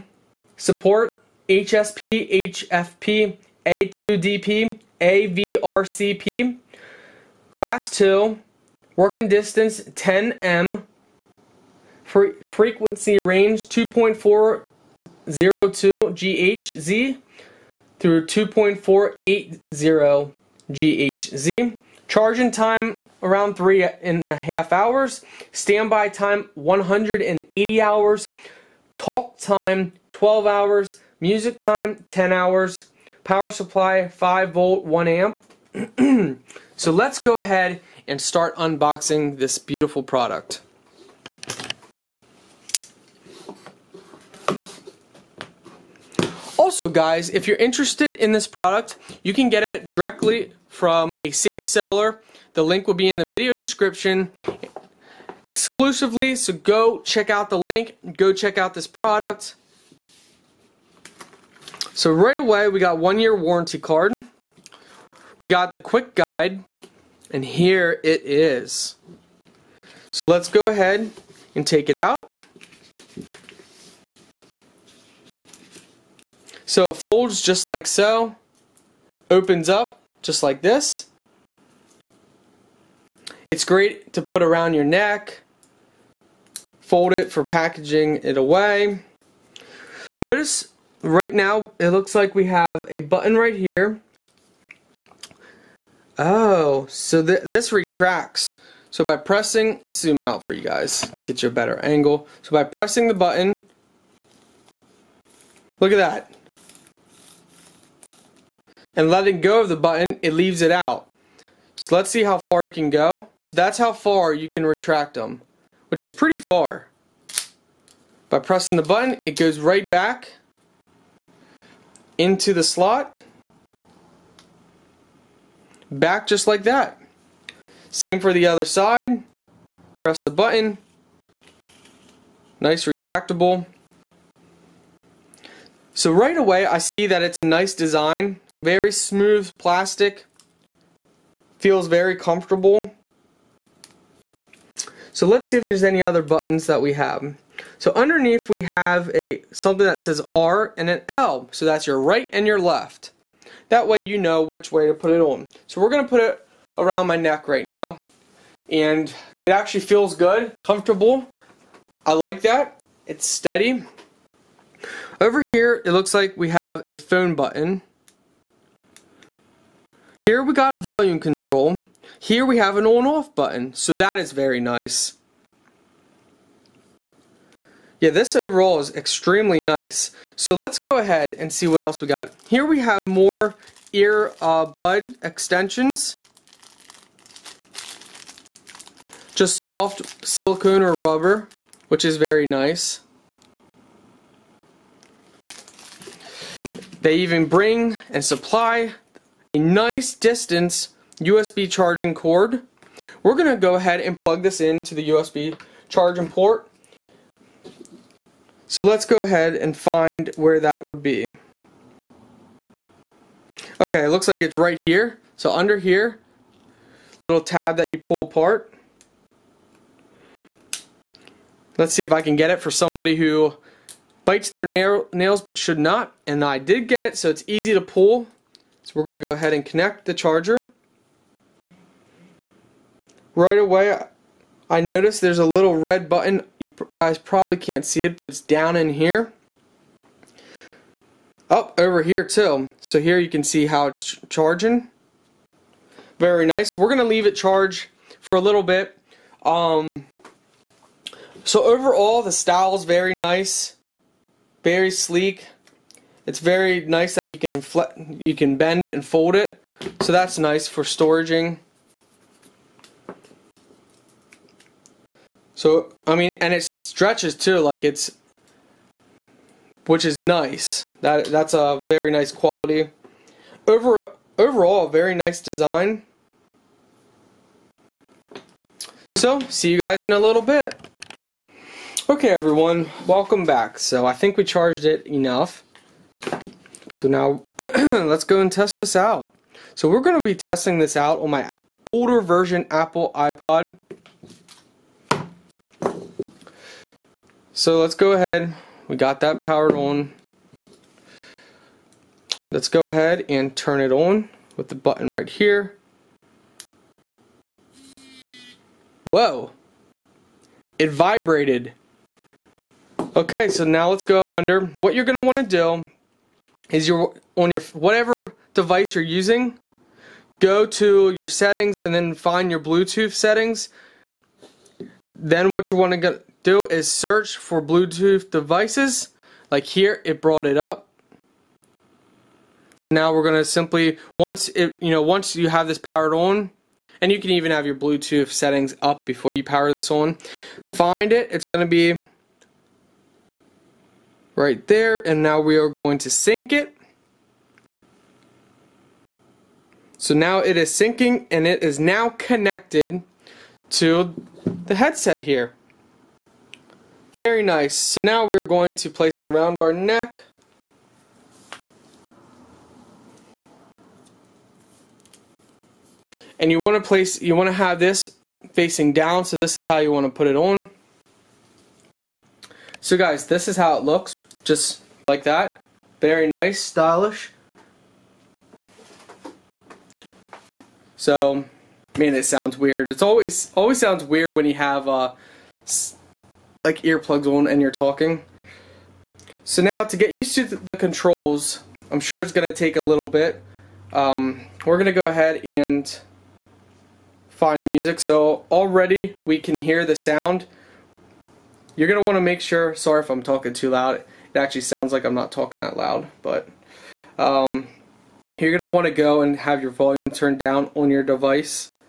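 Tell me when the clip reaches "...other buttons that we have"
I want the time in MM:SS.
02:26.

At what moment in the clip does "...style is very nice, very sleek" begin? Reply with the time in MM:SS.
04:12.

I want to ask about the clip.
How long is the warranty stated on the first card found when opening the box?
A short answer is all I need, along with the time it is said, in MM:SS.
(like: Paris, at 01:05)
1 year, at 01:02.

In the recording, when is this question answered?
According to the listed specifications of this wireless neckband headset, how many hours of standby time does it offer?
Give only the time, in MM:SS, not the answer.
00:26.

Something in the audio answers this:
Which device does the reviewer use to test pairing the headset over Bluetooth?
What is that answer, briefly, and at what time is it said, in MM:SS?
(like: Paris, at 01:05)
Apple iPod, at 04:52.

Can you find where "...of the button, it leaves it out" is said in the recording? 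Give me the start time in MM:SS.
01:49.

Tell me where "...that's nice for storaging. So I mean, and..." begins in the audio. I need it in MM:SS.
04:20.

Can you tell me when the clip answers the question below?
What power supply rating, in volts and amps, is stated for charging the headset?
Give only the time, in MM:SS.
00:34.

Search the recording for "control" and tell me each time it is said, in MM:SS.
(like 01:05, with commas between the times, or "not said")
02:51, 06:30.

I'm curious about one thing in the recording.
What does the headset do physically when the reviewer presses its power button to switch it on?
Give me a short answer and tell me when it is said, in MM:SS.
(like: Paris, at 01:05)
Vibrated, at 05:10.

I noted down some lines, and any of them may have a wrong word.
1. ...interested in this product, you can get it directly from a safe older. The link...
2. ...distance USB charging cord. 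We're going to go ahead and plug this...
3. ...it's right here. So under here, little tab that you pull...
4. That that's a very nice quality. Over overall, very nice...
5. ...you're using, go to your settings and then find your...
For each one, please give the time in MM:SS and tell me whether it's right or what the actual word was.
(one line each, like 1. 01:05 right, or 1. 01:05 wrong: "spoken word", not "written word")
1. 00:47 wrong: "seller", not "older"
2. 03:20 right
3. 03:34 right
4. 04:31 right
5. 05:18 right.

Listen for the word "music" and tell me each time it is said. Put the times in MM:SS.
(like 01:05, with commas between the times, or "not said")
00:31, 06:37.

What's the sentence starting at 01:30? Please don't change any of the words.
Notice right now it looks like we have a button right here Oh, so th this retracts.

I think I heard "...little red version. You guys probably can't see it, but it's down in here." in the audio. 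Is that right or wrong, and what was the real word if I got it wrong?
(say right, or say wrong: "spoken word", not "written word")
wrong: "button", not "version".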